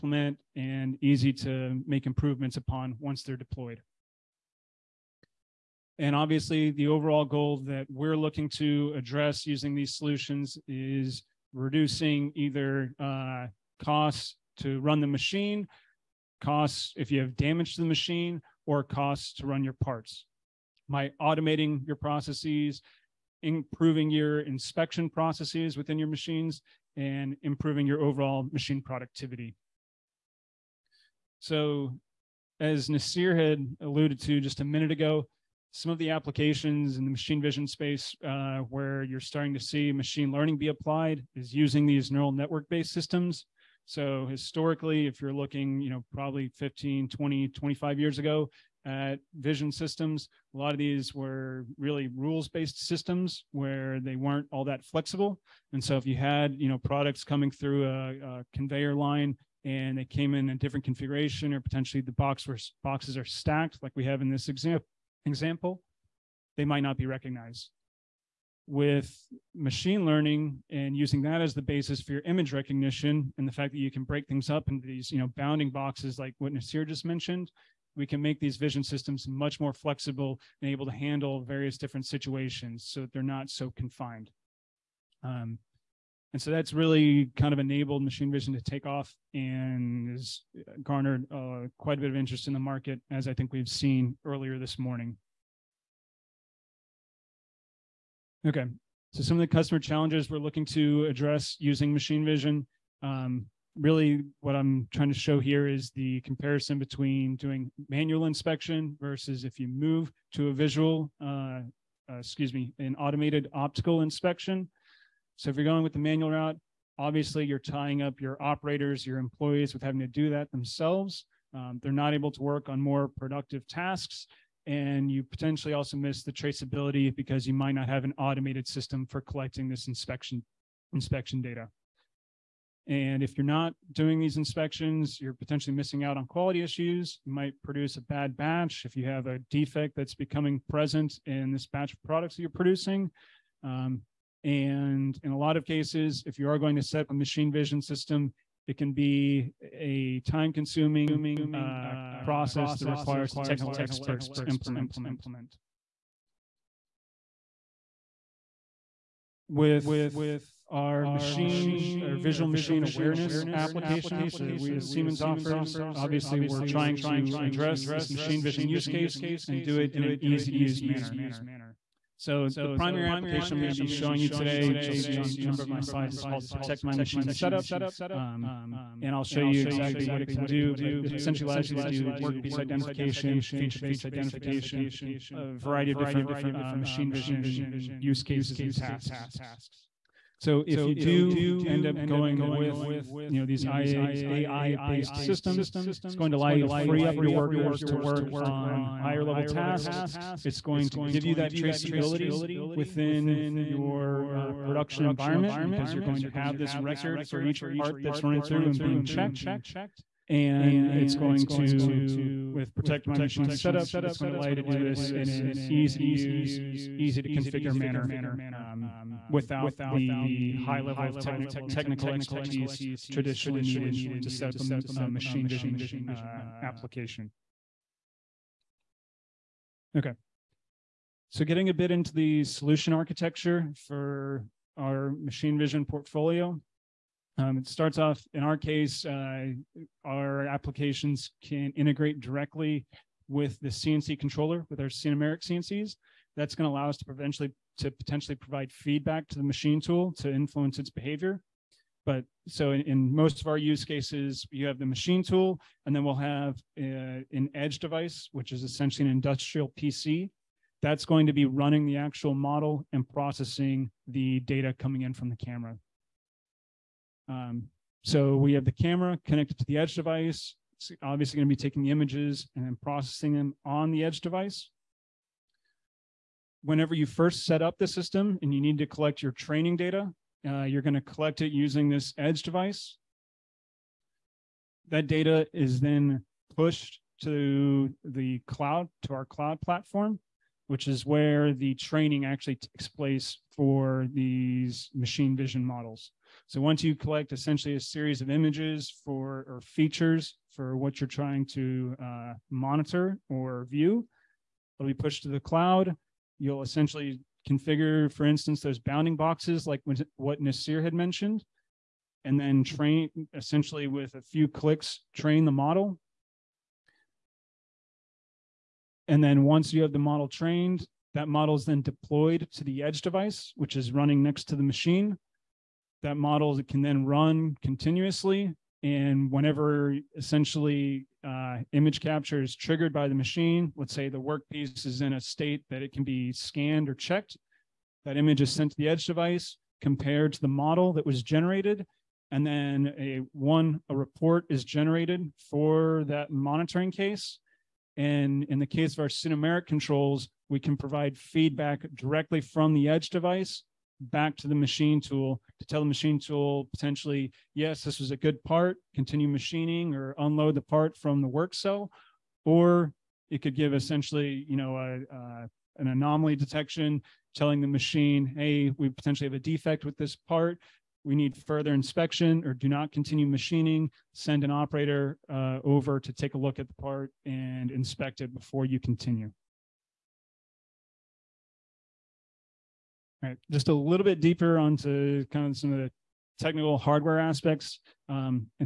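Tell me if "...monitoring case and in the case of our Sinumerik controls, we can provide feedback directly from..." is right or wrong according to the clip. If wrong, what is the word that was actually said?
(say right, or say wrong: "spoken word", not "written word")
right.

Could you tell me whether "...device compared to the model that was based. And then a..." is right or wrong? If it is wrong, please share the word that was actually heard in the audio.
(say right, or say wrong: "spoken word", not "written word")
wrong: "generated", not "based".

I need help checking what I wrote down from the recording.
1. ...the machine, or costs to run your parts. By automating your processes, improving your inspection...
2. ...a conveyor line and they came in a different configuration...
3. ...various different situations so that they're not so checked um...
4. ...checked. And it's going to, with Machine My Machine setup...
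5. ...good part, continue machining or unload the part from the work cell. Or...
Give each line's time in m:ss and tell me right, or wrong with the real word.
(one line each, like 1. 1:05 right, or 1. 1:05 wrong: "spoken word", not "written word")
1. 0:17 right
2. 0:58 right
3. 1:21 wrong: "confined", not "checked"
4. 3:29 wrong: "Protect", not "Machine"
5. 5:58 right.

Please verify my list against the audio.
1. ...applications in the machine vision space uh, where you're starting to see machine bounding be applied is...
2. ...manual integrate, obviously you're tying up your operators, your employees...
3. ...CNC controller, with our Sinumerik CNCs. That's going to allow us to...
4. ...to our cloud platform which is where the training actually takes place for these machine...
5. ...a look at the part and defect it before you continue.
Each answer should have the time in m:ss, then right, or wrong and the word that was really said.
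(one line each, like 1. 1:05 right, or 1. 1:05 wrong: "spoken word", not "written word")
1. 0:36 wrong: "learning", not "bounding"
2. 1:55 wrong: "route", not "integrate"
3. 4:03 right
4. 4:49 right
5. 6:16 wrong: "inspect", not "defect".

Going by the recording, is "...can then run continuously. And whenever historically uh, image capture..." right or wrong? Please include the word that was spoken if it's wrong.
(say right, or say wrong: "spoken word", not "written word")
wrong: "essentially", not "historically".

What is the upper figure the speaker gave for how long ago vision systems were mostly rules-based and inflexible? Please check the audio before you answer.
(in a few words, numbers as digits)
25 years.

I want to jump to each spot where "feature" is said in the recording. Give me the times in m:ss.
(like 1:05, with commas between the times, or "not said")
3:03, 4:59.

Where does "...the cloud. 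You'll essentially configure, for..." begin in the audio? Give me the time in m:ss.
5:05.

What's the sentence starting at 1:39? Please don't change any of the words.
So some of the customer challenges we're looking to address using machine vision.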